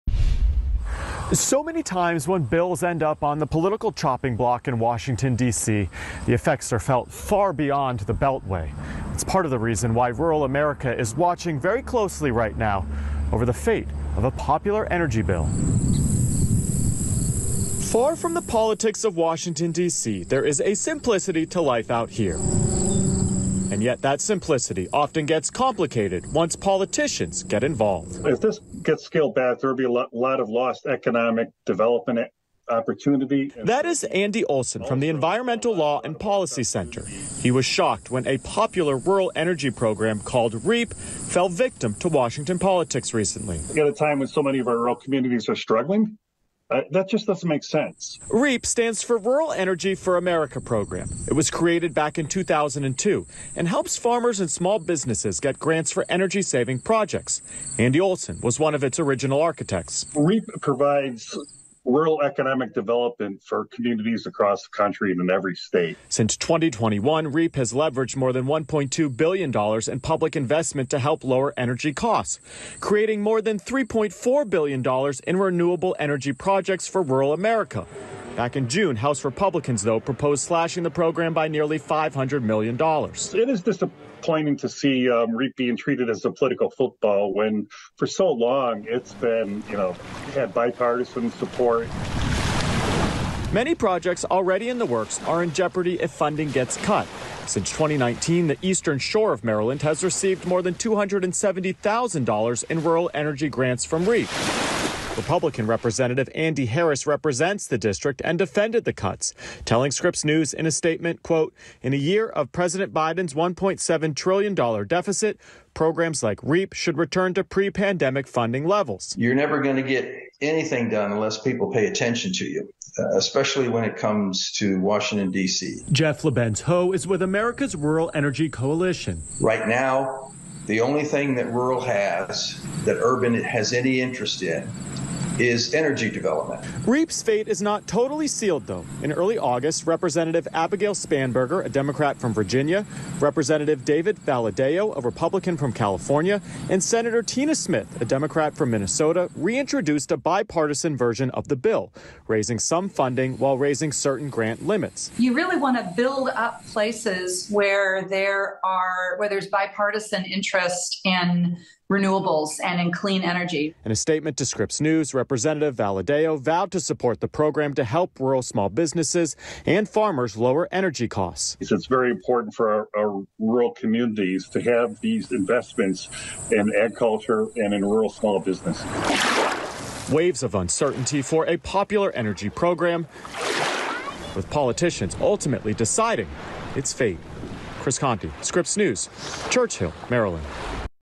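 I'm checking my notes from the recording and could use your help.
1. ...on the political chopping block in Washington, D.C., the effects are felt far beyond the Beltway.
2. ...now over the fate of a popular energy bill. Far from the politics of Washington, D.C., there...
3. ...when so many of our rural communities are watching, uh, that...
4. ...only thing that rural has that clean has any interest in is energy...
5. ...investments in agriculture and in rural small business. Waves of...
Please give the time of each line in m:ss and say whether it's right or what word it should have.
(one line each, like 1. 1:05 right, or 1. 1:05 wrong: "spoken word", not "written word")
1. 0:03 right
2. 0:12 right
3. 0:44 wrong: "struggling", not "watching"
4. 2:10 wrong: "urban", not "clean"
5. 2:55 right.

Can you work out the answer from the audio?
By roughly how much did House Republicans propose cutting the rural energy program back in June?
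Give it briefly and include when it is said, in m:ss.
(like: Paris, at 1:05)
nearly $500 million, at 1:21.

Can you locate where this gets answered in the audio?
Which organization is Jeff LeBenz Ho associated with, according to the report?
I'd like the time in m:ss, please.
2:07.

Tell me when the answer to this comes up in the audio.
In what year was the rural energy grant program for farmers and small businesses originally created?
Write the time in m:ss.
0:52.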